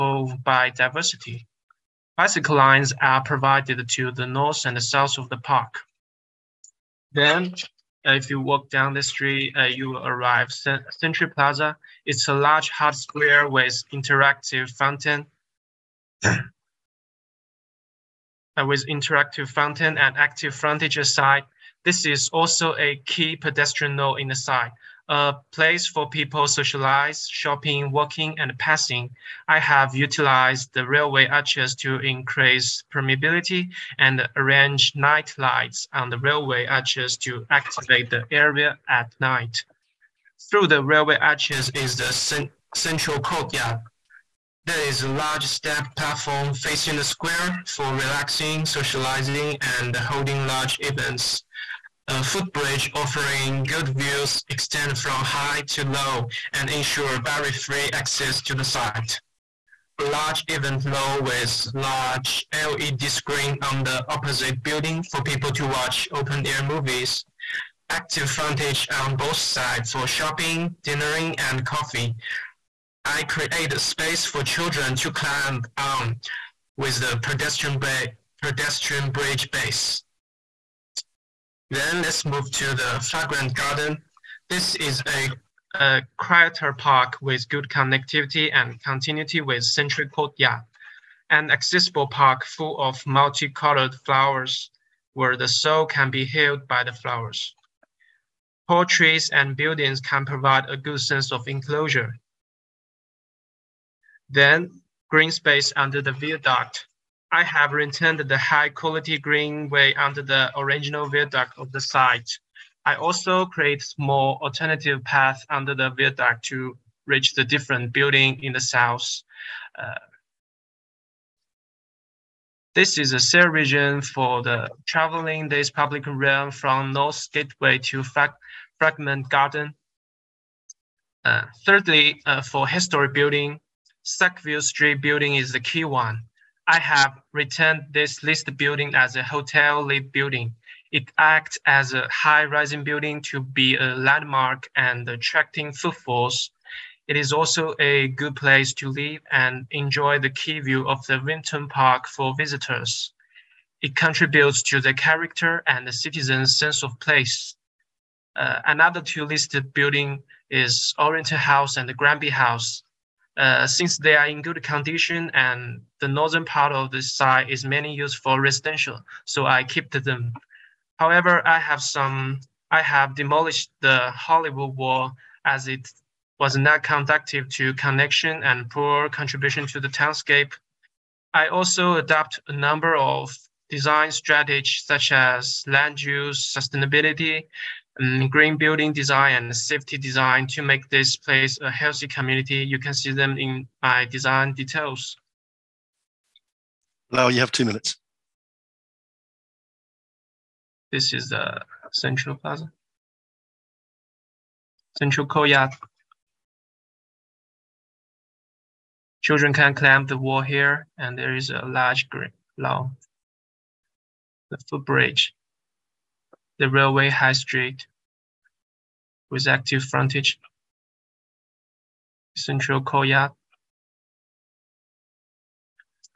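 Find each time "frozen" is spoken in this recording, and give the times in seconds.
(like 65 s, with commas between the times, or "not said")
not said.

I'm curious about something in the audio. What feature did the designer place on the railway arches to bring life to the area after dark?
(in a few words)
Night lights.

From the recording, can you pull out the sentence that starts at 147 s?
It is also a good place to live and enjoy the key view of the Vimto Park for visitors.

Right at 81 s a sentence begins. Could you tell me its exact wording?
Then let's move to the Fragrant Garden.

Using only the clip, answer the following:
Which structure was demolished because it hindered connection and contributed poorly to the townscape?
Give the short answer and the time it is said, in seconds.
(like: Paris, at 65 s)
The Hollywood wall, at 174 s.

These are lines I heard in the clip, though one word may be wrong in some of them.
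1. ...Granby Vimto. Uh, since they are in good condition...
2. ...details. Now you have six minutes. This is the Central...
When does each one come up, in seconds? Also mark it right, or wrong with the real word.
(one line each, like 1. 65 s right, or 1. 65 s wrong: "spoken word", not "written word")
1. 161 s wrong: "House", not "Vimto"
2. 194 s wrong: "two", not "six".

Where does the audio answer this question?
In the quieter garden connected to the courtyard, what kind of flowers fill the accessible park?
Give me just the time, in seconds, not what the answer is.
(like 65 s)
93 s.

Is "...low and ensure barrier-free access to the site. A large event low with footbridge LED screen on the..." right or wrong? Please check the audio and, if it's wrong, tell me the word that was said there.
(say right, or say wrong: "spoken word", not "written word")
wrong: "large", not "footbridge".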